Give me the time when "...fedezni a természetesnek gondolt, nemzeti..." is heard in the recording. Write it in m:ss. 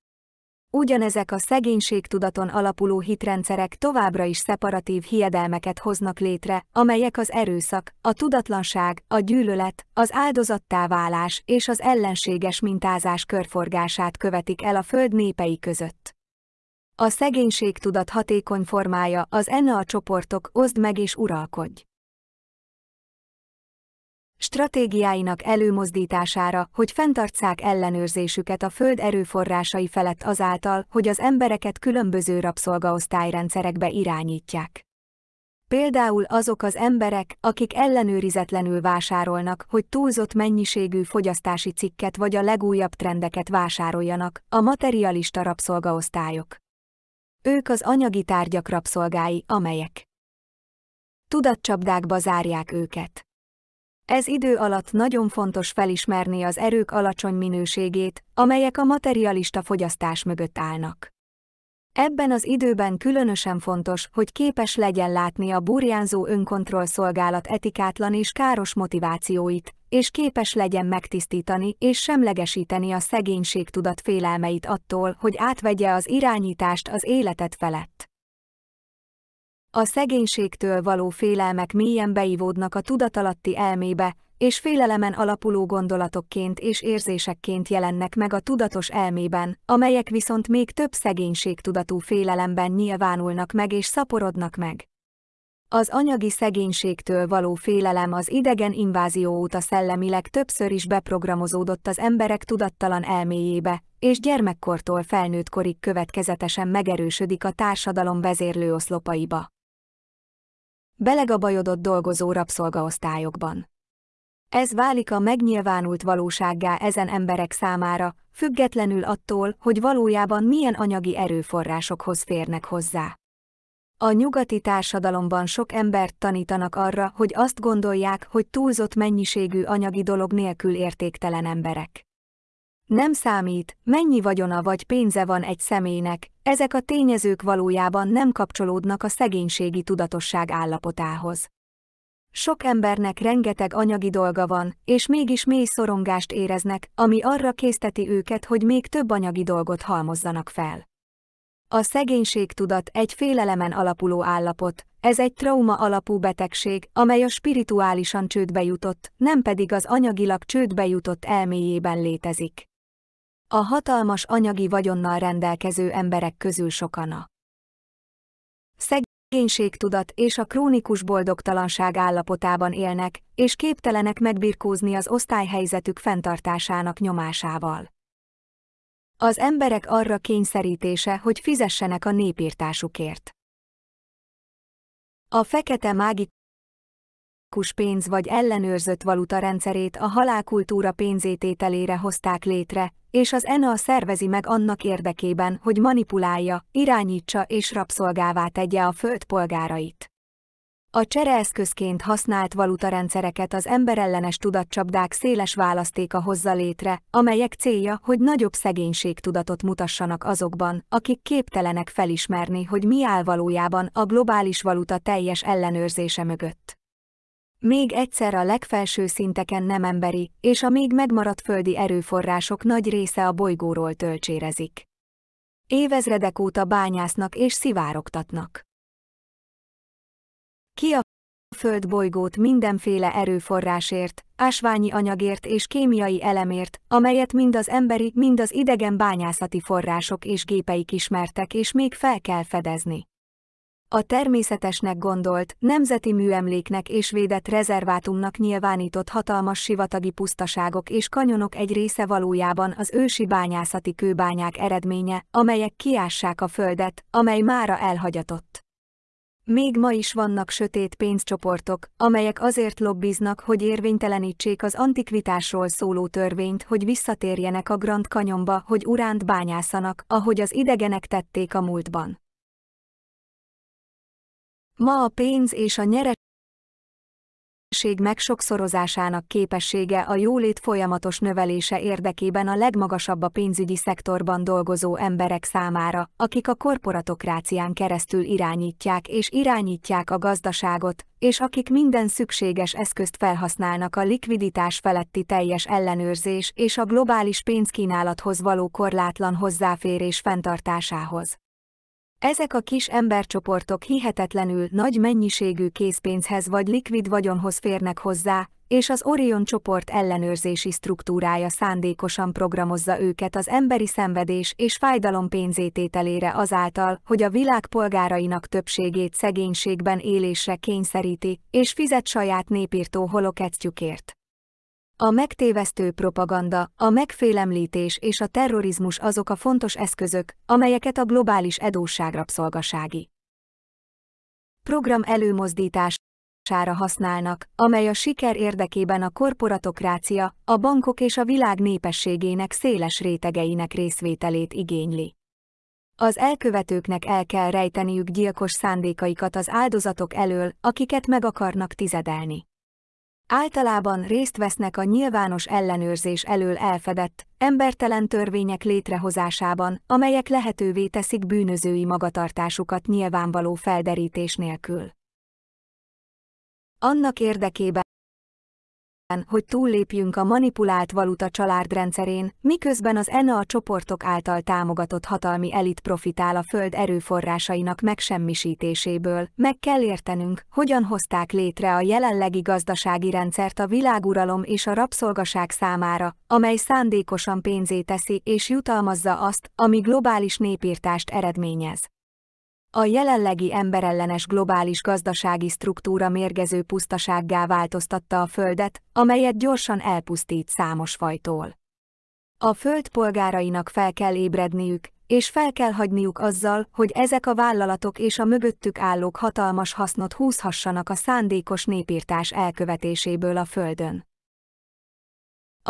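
4:02.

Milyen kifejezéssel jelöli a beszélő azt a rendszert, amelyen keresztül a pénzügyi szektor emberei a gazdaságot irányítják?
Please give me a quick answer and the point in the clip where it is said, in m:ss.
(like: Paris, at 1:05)
korporatokrácia, at 4:46.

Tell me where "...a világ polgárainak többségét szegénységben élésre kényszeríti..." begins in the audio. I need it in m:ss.
5:17.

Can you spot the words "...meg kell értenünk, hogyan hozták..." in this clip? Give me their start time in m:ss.
6:19.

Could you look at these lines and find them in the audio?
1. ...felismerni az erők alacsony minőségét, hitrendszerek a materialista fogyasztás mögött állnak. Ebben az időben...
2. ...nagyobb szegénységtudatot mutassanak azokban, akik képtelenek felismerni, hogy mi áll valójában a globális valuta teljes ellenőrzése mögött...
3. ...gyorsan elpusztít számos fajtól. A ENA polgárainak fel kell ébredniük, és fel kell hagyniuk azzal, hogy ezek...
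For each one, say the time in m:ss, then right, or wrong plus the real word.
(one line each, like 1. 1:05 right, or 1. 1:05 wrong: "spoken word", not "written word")
1. 0:55 wrong: "amelyek", not "hitrendszerek"
2. 3:28 right
3. 6:39 wrong: "Föld", not "ENA".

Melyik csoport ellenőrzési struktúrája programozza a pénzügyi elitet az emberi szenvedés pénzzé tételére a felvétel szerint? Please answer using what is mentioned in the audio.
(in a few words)
Orion csoport.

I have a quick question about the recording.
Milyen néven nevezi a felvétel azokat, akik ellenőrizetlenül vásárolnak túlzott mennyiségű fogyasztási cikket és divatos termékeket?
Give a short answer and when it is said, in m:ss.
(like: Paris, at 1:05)
materialista rabszolgaosztályok, at 0:44.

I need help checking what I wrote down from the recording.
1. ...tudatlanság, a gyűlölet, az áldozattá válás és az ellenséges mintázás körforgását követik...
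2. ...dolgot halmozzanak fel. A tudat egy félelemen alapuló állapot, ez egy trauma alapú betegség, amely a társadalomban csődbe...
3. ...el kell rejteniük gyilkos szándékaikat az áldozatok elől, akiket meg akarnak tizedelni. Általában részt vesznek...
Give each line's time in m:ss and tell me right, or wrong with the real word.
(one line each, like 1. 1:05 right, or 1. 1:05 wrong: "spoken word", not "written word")
1. 0:08 right
2. 2:29 wrong: "spirituálisan", not "társadalomban"
3. 5:47 right.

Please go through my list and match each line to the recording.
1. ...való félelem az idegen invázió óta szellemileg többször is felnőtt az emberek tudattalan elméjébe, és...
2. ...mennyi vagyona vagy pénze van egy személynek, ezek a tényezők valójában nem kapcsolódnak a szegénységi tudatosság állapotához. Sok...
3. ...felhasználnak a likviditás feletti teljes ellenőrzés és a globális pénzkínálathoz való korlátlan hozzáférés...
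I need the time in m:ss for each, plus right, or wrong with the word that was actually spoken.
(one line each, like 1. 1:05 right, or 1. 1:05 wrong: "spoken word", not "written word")
1. 1:37 wrong: "beprogramozódott", not "felnőtt"
2. 2:13 right
3. 4:53 right.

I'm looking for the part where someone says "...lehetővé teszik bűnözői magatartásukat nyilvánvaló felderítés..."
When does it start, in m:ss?
6:00.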